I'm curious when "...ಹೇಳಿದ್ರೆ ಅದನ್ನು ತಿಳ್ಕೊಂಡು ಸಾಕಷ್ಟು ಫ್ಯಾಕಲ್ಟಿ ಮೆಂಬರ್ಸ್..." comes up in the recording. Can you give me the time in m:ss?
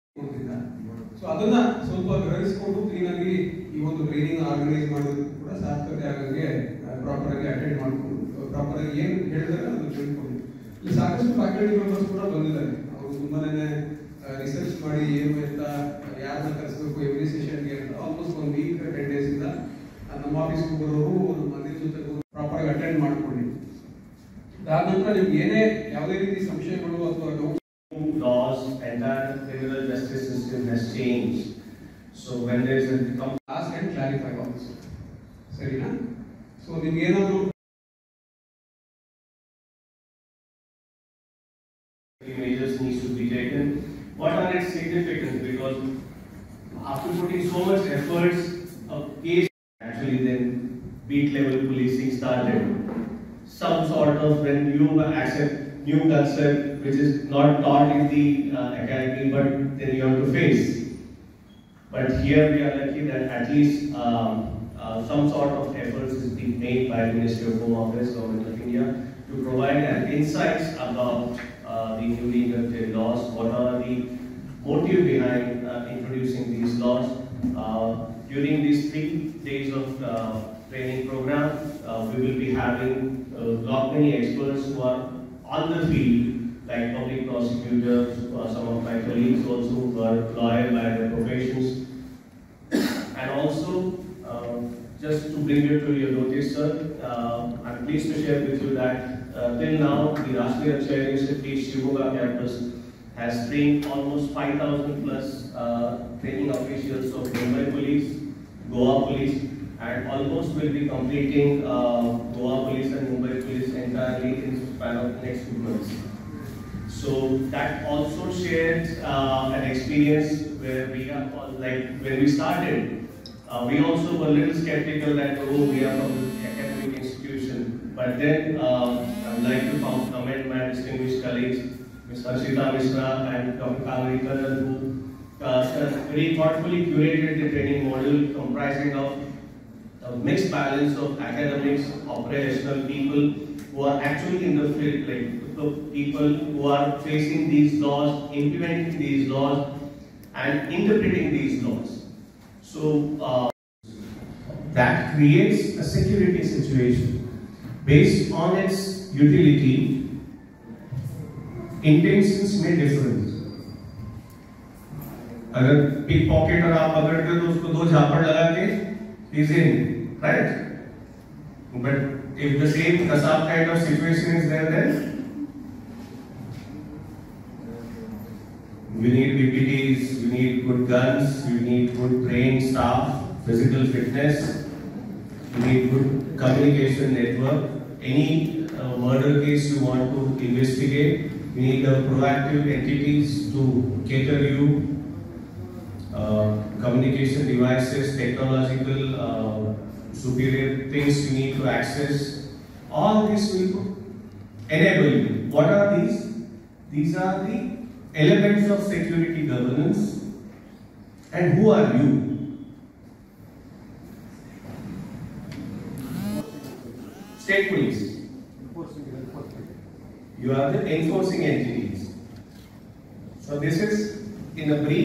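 0:09.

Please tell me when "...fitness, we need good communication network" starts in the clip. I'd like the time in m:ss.
3:03.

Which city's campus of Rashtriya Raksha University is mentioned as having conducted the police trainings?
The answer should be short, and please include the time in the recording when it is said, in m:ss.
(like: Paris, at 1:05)
Shivamogga, at 1:41.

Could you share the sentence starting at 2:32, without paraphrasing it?
So uh, that creates a security situation based on its utility.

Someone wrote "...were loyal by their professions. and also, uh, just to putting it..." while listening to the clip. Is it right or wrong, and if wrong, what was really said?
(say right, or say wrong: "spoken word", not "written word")
wrong: "bring", not "putting".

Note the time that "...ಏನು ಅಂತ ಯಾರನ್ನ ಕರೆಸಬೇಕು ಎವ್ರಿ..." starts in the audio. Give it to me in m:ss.
0:15.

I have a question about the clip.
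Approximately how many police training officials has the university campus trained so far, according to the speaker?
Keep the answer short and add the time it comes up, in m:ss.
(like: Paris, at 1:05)
5,000, at 1:44.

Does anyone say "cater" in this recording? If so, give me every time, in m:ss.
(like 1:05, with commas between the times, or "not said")
3:14.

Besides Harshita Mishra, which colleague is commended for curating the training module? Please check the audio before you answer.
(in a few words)
Dr. Kaveri.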